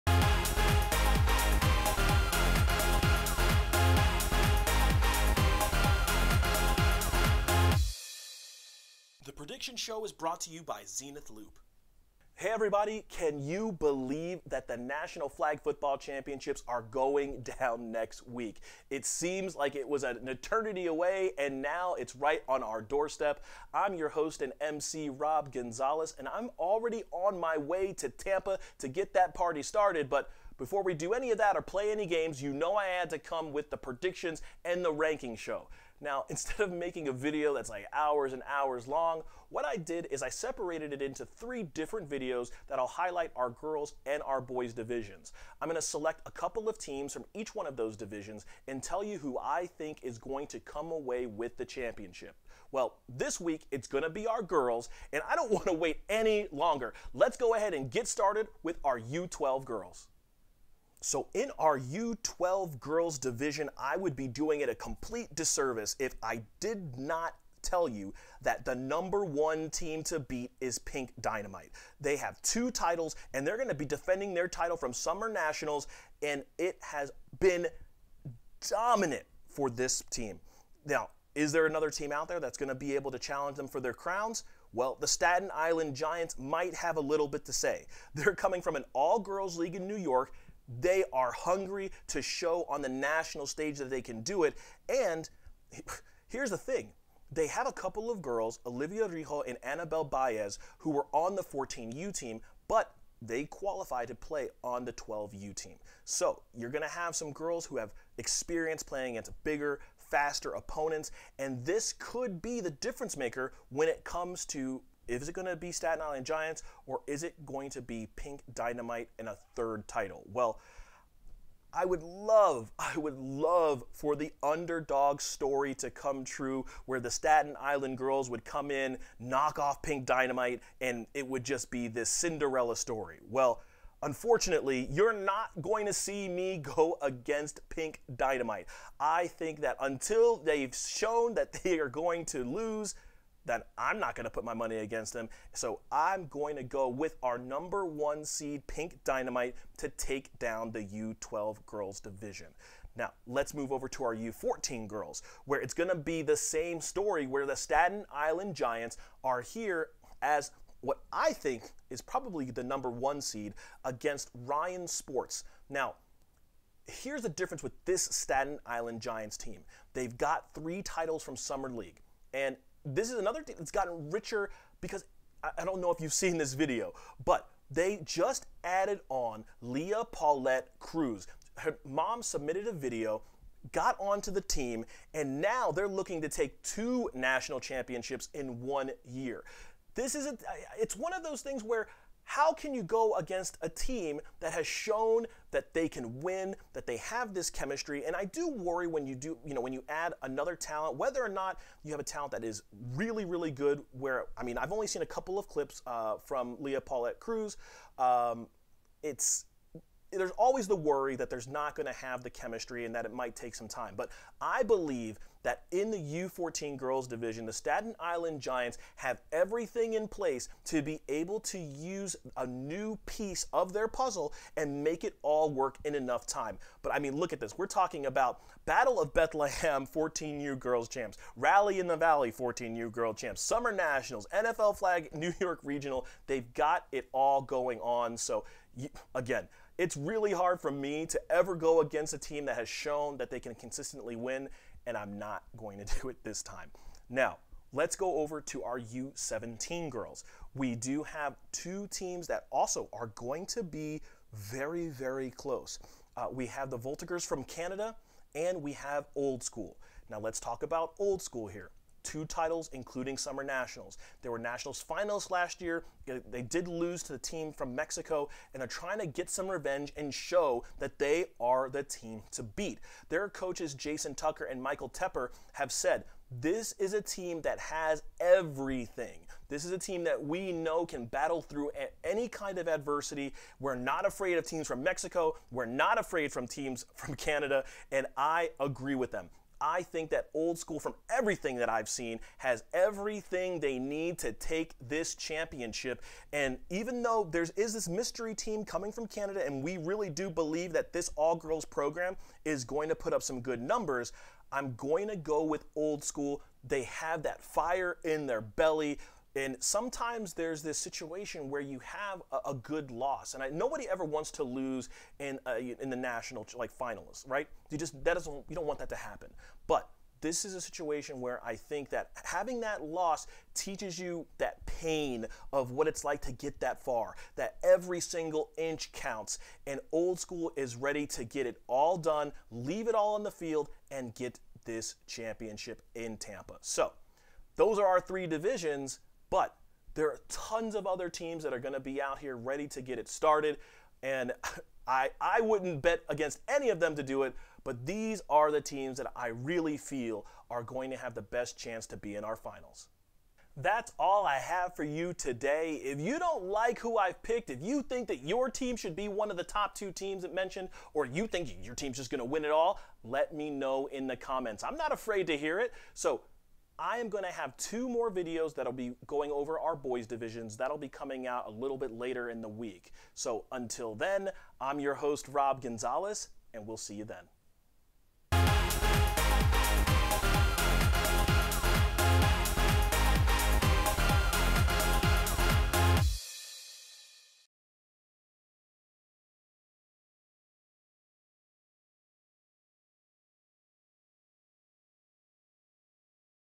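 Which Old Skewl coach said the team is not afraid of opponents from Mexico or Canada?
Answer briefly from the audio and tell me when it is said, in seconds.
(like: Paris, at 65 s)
Jason Tucker, at 273 s.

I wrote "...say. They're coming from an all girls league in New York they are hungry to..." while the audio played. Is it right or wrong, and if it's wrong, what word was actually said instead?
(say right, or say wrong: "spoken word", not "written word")
right.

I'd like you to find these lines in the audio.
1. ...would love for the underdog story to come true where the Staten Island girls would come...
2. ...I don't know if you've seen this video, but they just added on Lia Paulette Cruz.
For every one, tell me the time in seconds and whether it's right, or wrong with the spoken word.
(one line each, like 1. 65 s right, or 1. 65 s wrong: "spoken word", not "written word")
1. 122 s right
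2. 175 s right.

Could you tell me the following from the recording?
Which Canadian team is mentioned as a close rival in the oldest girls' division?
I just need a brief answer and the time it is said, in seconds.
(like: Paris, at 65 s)
Voltigeurs, at 256 s.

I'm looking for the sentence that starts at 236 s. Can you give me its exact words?
They've got it all going on.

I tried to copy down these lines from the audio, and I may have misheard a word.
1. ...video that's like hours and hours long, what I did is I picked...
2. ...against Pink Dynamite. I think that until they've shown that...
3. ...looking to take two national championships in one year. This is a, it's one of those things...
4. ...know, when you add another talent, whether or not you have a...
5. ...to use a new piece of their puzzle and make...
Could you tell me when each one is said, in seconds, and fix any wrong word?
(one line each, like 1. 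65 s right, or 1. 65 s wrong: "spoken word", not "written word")
1. 37 s wrong: "separated", not "picked"
2. 137 s right
3. 185 s right
4. 199 s right
5. 221 s right.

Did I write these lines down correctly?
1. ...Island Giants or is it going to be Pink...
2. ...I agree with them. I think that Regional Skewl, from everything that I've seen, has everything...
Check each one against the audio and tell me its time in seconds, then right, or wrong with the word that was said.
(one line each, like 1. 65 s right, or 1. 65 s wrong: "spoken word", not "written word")
1. 116 s right
2. 288 s wrong: "Old", not "Regional".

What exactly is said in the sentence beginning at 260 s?
Now, let's talk about Old Skewl here two titles, including Summer Nationals.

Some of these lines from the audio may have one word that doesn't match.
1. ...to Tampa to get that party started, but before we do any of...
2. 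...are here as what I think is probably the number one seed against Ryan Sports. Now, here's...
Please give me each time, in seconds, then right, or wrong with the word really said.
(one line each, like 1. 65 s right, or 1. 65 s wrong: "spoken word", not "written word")
1. 27 s right
2. 159 s right.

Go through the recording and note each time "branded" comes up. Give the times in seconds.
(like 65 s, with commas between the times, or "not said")
not said.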